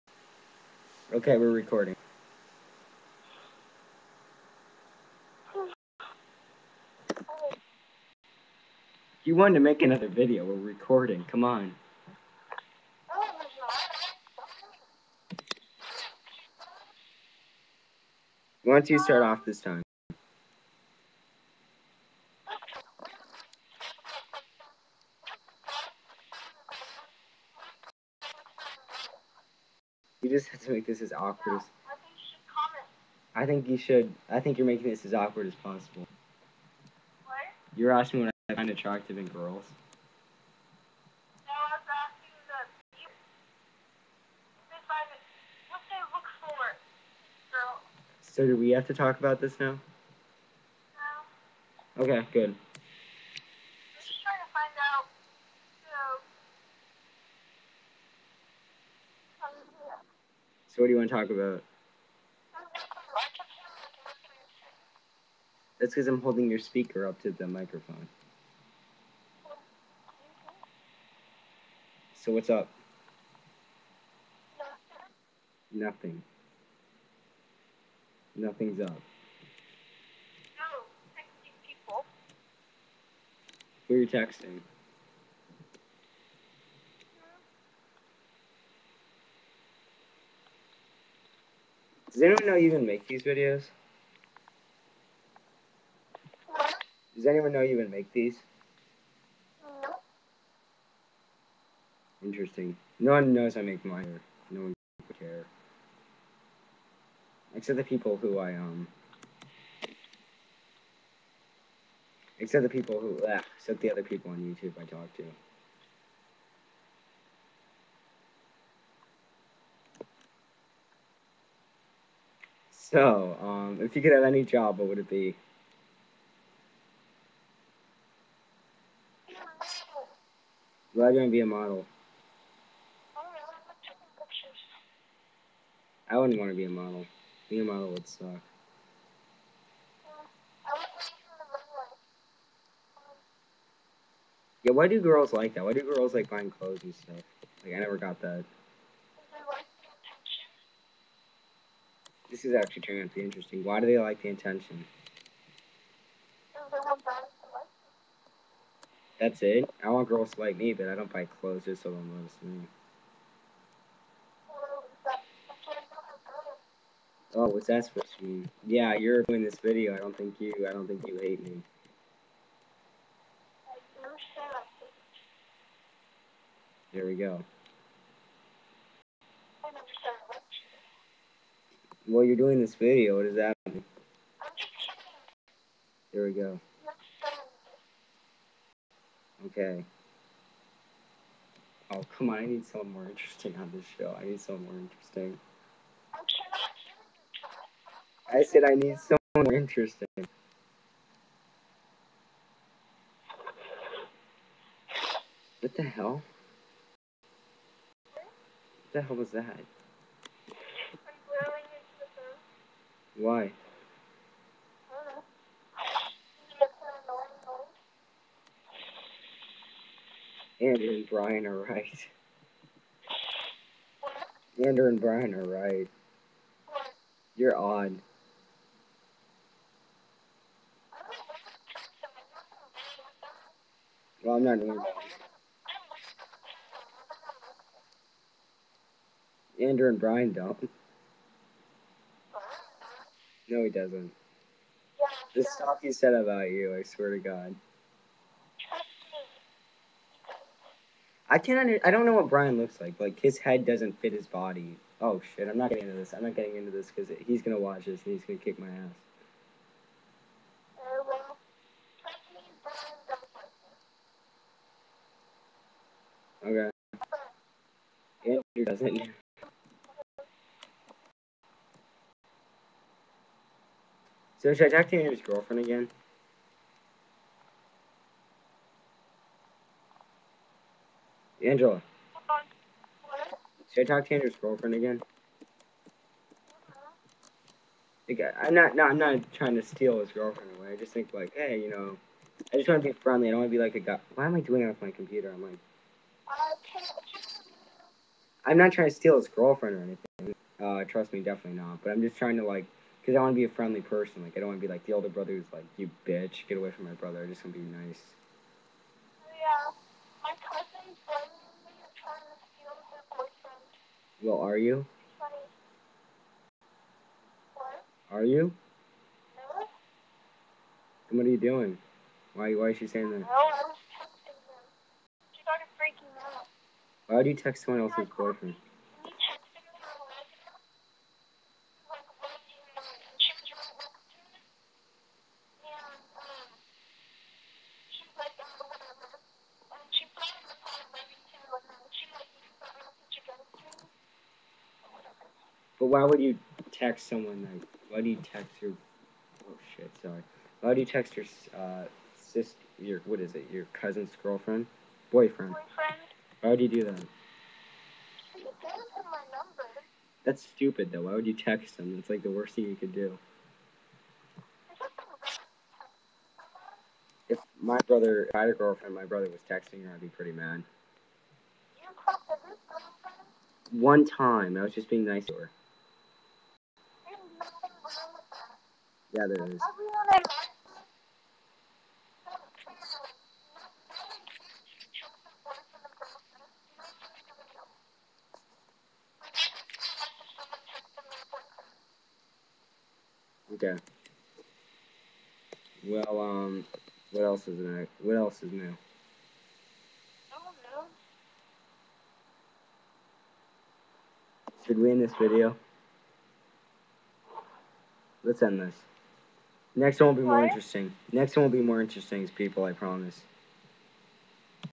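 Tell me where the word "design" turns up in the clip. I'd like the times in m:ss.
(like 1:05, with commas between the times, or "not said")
not said.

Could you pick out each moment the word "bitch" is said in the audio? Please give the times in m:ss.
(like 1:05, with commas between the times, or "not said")
5:06.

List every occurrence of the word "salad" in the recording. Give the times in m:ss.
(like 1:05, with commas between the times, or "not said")
not said.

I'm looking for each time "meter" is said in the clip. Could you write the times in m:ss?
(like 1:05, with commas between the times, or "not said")
not said.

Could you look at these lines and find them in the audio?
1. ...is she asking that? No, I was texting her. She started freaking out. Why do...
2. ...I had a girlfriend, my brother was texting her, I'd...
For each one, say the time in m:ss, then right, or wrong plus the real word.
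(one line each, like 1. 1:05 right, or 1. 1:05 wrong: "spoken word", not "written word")
1. 5:22 wrong: "saying", not "asking"
2. 6:08 right.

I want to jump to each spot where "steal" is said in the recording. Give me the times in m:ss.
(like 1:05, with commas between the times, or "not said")
4:49, 4:58, 5:12.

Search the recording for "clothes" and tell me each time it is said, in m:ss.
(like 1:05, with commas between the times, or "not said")
2:26, 2:41.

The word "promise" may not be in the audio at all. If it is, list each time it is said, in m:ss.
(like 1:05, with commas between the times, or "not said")
6:52.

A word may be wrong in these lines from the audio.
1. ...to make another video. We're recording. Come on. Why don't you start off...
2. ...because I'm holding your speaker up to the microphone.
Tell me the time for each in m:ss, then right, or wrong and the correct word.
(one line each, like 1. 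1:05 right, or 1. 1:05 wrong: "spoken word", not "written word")
1. 0:09 right
2. 1:05 right.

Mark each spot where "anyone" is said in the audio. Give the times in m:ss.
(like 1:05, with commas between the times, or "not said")
1:32, 1:37.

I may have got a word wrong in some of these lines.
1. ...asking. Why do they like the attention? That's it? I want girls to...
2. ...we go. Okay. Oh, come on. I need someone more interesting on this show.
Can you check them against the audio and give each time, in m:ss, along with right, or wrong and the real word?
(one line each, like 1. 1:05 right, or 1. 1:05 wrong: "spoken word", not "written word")
1. 2:33 wrong: "interesting", not "asking"
2. 3:06 right.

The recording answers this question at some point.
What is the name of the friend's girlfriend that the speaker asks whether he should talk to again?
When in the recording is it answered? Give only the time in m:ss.
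4:41.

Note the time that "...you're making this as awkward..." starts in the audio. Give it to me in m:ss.
0:34.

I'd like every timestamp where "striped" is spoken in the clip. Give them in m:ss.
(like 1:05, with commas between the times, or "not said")
not said.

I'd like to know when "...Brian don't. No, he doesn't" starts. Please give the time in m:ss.
3:59.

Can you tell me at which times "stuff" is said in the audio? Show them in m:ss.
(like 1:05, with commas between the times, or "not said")
2:26, 4:05.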